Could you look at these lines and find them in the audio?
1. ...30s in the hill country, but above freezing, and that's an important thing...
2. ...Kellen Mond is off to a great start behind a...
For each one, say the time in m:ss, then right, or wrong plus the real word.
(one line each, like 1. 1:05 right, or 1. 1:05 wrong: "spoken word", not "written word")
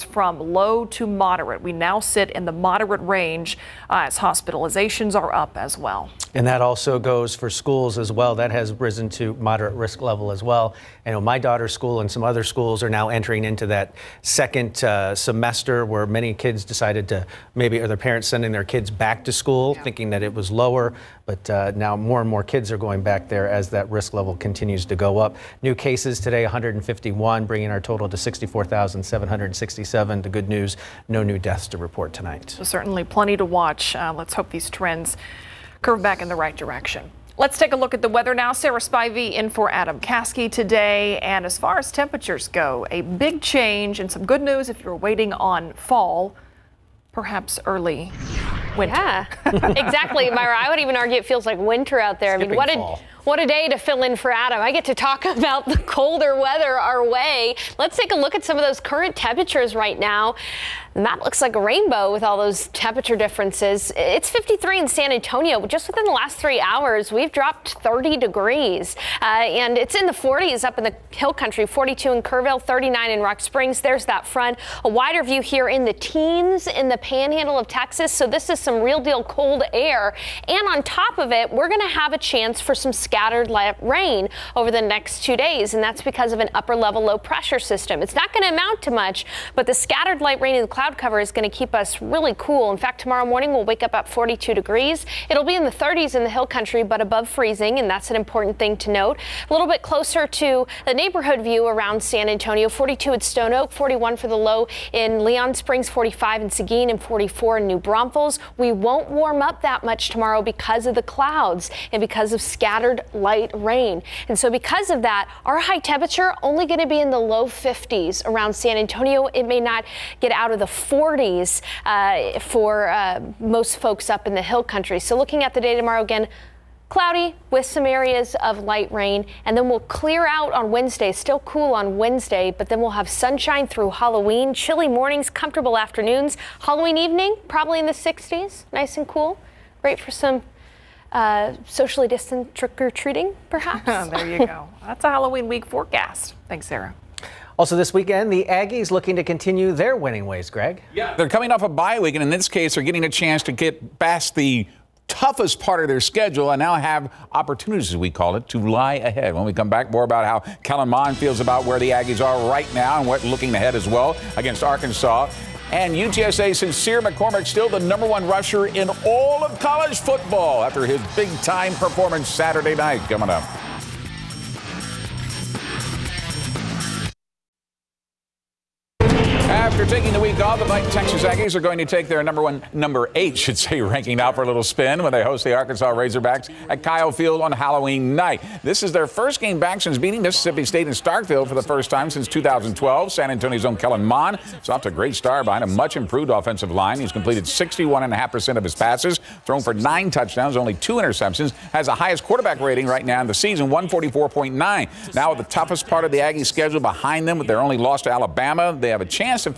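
1. 1:35 right
2. 3:13 right.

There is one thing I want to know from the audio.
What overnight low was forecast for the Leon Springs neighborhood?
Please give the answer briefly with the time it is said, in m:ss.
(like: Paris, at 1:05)
41, at 1:43.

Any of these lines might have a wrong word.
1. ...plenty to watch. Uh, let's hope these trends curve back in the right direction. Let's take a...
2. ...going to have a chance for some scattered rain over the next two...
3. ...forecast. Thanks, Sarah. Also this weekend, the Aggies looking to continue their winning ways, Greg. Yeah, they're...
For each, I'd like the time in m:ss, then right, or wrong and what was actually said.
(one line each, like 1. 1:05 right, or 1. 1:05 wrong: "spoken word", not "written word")
1. 0:33 right
2. 1:21 right
3. 2:25 right.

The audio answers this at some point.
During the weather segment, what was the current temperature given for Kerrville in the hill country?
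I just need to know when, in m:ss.
1:11.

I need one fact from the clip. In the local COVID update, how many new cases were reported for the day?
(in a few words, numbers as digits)
151.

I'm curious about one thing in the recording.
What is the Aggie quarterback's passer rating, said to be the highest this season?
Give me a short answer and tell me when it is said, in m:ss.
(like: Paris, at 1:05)
144.9, at 3:23.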